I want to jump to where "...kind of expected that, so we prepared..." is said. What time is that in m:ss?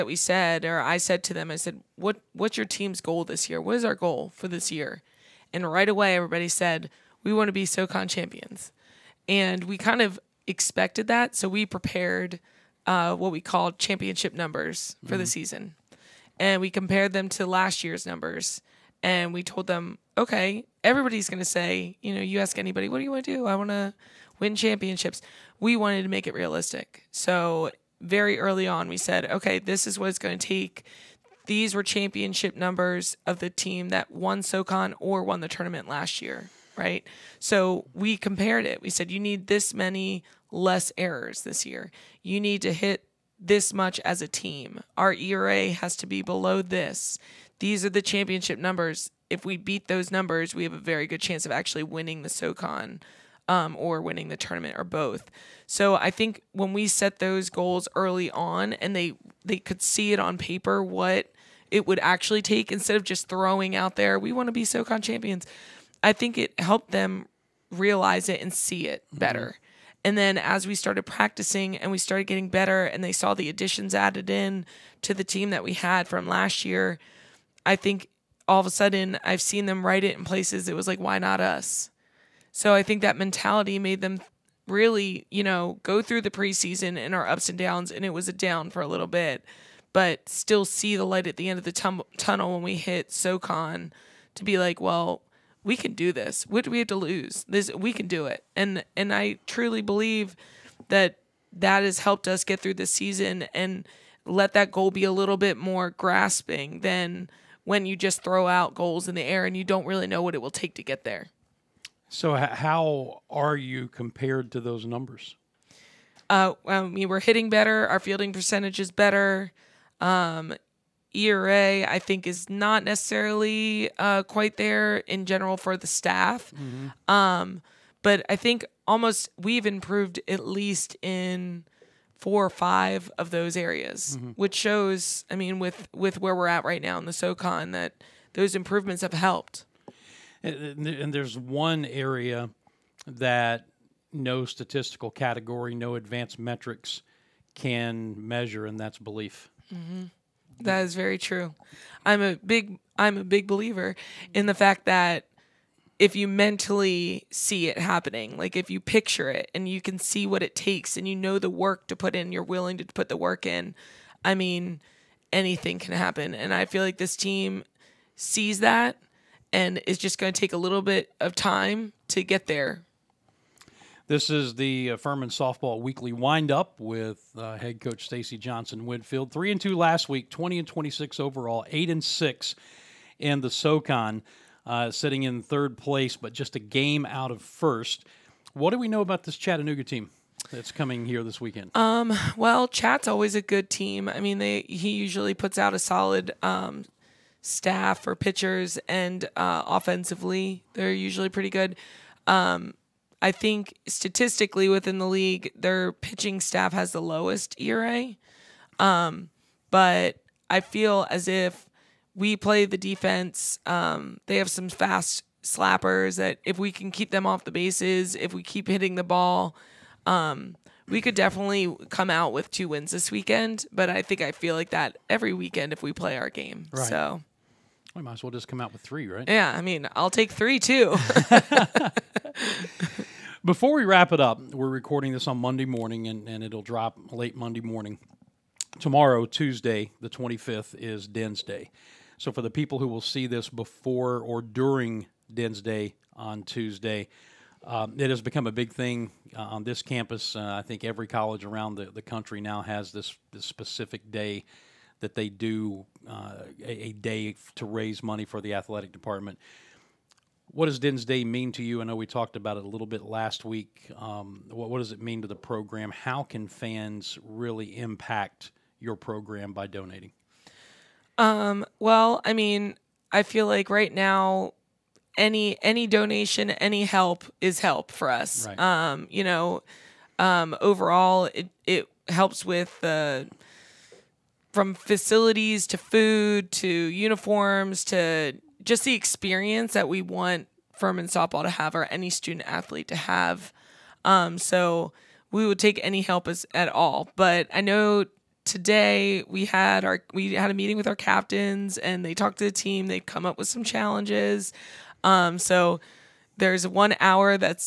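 0:09.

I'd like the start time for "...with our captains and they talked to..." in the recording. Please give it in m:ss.
5:00.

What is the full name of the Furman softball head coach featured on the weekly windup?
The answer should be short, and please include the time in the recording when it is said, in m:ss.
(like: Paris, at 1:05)
Stacy Johnson Whitfield, at 2:58.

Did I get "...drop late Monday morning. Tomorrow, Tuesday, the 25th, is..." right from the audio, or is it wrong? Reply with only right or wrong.
right.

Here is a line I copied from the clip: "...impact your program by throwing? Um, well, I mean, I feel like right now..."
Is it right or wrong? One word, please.
wrong.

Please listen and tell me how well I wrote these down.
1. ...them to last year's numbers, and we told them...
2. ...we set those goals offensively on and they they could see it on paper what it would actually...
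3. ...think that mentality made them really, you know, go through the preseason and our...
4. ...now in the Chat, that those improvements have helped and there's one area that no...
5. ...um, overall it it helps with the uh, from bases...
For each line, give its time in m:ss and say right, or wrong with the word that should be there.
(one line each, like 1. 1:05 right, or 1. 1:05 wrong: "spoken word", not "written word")
1. 0:17 right
2. 0:56 wrong: "early", not "offensively"
3. 1:22 right
4. 2:16 wrong: "SoCon", not "Chat"
5. 4:40 wrong: "facilities", not "bases".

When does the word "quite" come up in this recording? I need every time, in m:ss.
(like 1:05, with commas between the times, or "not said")
2:04.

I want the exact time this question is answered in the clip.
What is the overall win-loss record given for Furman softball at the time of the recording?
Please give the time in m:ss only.
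3:00.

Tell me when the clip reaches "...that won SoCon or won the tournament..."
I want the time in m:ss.
0:33.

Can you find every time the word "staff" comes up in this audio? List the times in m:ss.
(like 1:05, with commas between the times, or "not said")
2:05, 3:17, 3:26.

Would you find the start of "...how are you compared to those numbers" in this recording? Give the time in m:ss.
1:52.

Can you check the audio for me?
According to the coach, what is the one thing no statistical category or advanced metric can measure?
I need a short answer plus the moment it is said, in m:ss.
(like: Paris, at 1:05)
Belief, at 2:28.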